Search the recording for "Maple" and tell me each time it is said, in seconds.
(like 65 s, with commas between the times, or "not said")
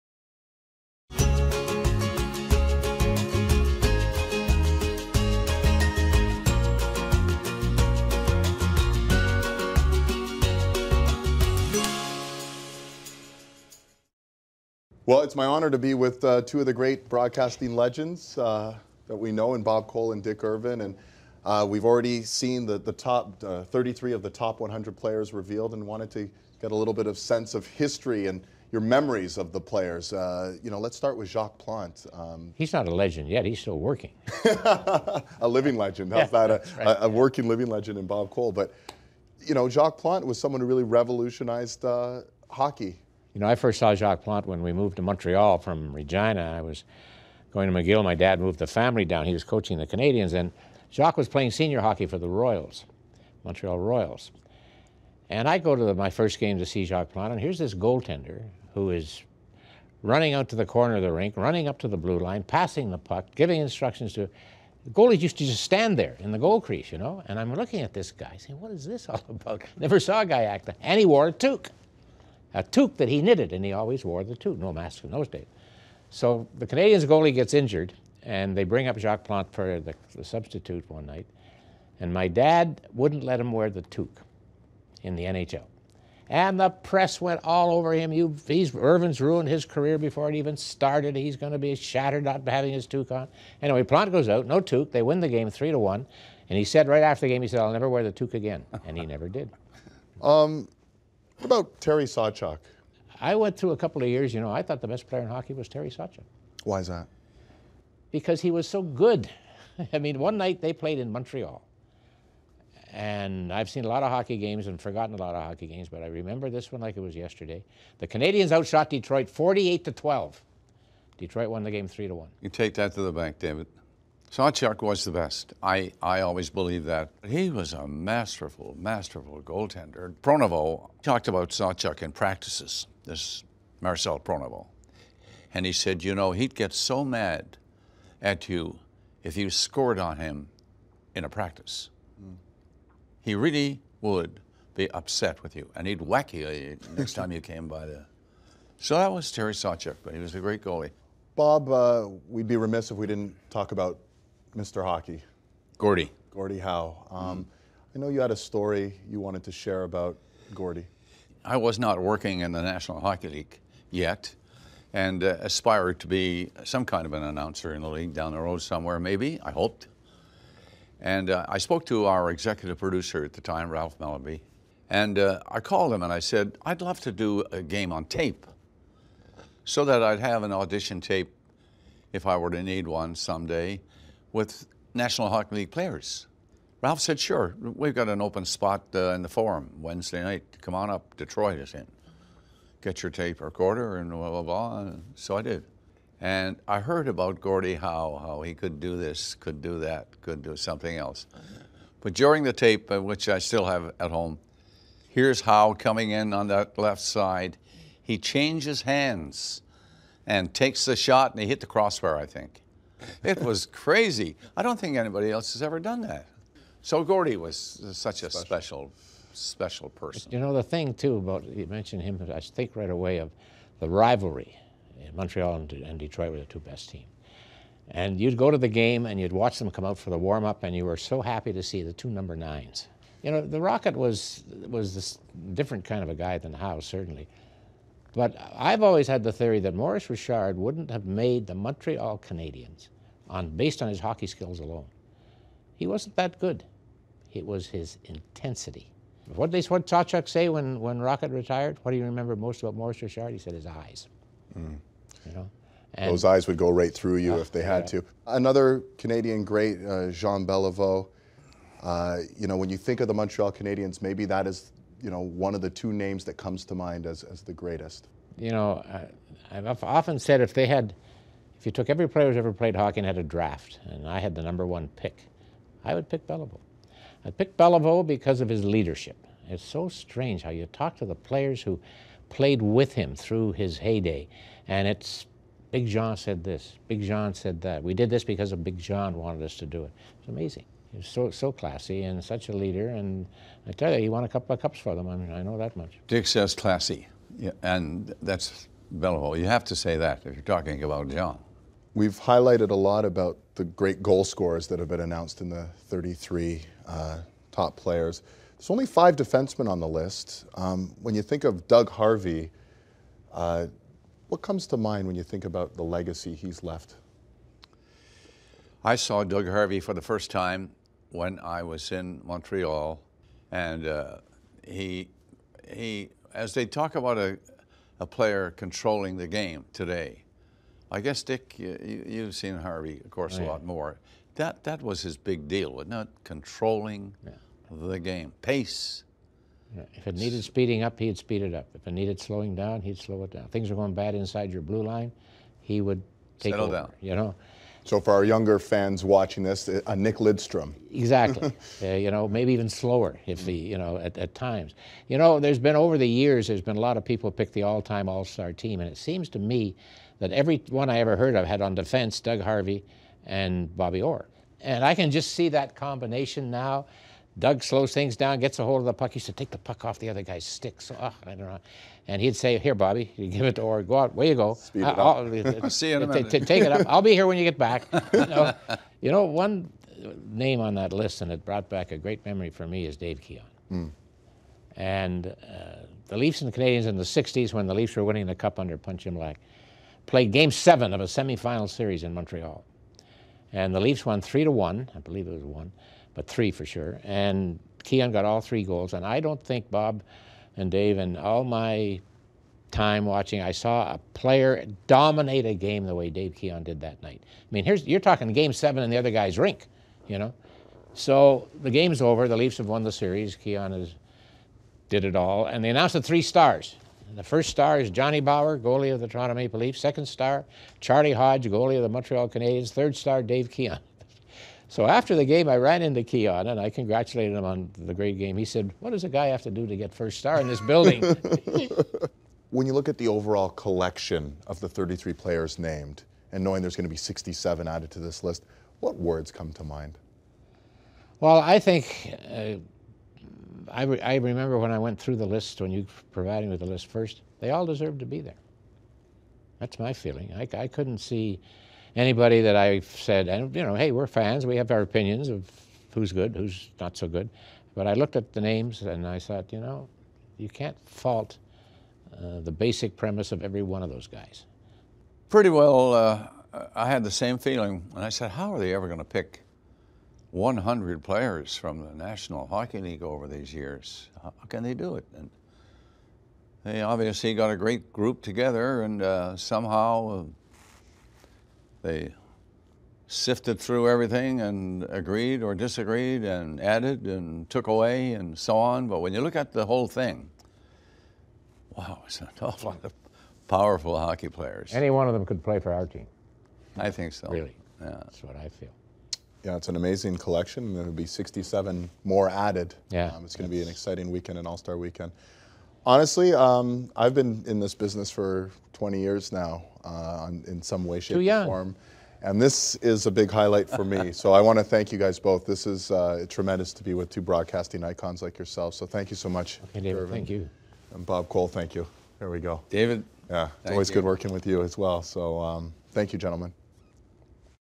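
419 s.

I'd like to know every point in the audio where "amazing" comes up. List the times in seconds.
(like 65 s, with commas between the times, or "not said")
290 s, 499 s.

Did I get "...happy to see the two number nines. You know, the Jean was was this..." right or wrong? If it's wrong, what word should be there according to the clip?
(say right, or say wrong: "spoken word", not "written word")
wrong: "Rocket", not "Jean".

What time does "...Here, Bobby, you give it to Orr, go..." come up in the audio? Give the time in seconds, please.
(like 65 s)
372 s.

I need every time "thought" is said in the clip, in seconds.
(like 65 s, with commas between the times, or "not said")
104 s, 459 s.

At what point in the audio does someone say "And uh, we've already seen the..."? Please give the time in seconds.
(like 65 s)
20 s.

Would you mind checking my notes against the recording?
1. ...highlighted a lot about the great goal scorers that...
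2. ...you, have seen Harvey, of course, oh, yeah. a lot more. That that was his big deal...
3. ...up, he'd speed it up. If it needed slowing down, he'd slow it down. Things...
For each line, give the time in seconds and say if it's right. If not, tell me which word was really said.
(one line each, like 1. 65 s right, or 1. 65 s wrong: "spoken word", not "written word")
1. 302 s right
2. 331 s right
3. 340 s right.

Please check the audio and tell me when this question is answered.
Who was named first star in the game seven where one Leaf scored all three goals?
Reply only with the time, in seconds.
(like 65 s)
417 s.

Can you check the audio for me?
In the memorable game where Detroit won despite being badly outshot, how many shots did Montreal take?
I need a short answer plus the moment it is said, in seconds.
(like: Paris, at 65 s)
48, at 119 s.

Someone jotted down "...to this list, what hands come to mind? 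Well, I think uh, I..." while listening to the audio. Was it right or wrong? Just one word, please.
wrong.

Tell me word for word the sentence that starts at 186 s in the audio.
Ralph said, sure, we've got an open spot uh, in the forum Wednesday night.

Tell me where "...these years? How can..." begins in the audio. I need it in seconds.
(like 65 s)
473 s.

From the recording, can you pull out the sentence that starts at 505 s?
Honestly, um, I've been in this business for 20 years now.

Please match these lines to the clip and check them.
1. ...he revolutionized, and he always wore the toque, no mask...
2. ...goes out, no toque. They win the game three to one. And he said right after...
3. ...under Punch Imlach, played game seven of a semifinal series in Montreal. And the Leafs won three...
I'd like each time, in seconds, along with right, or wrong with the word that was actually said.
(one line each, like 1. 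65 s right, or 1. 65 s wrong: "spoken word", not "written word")
1. 73 s wrong: "knitted", not "revolutionized"
2. 94 s right
3. 388 s right.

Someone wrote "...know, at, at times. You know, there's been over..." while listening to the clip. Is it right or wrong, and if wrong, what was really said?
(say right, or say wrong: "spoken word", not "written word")
right.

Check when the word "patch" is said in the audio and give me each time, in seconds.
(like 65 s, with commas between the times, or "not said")
not said.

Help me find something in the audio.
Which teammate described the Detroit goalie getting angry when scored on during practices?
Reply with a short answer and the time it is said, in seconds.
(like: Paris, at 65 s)
Marcel Pronovost, at 133 s.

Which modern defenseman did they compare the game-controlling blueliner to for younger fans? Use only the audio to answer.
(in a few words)
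Nick Lidstrom.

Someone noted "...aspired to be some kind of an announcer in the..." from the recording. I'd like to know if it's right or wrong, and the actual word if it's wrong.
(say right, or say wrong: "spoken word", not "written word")
right.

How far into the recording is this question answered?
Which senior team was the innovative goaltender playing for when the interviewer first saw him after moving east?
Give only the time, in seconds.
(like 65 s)
53 s.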